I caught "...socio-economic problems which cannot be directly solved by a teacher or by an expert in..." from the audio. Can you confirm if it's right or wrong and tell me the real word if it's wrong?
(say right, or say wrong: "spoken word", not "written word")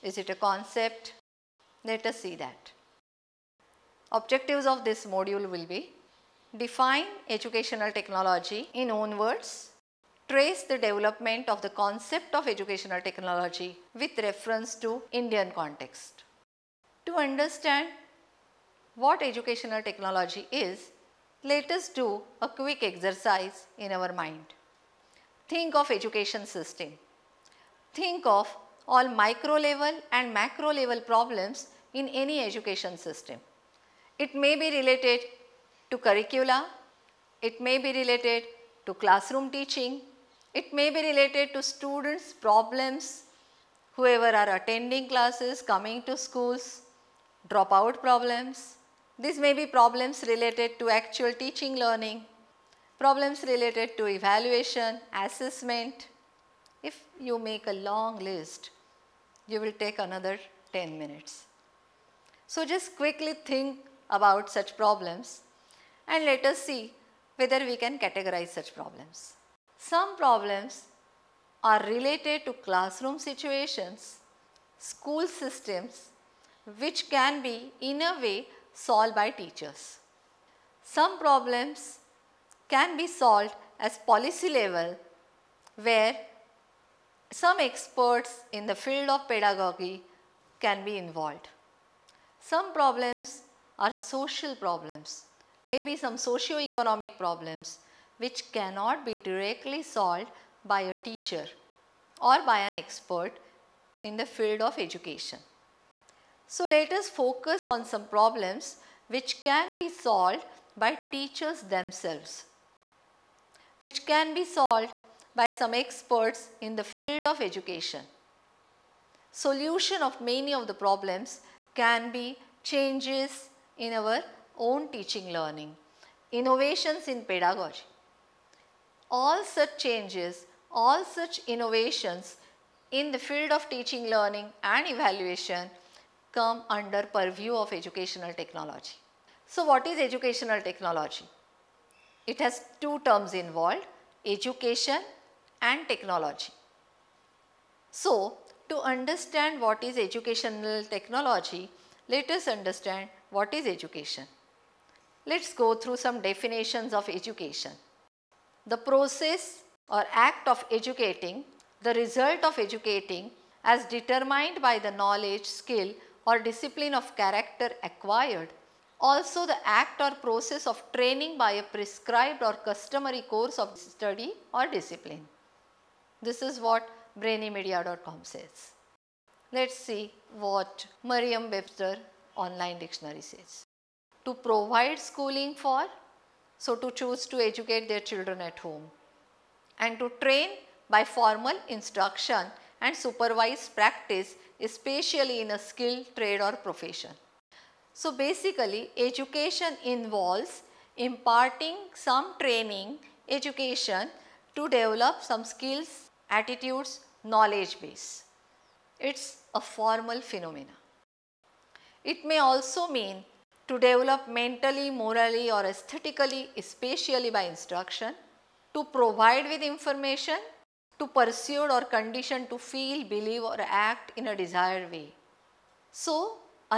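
right.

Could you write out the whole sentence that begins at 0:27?
Think of all micro level and macro level problems in any education system.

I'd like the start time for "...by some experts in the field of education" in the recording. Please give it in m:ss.
1:55.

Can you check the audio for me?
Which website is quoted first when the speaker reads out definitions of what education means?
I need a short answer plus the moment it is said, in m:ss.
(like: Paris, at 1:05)
brainymedia.com, at 2:57.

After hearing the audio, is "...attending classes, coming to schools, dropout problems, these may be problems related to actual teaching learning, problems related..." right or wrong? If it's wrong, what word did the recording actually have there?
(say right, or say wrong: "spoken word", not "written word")
right.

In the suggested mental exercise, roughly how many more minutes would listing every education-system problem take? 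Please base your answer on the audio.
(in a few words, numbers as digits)
10 minutes.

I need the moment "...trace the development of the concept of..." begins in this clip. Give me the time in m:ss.
0:10.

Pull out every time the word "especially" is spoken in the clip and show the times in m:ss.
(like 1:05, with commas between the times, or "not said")
3:14, 3:36.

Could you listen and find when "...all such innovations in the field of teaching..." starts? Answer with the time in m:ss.
2:10.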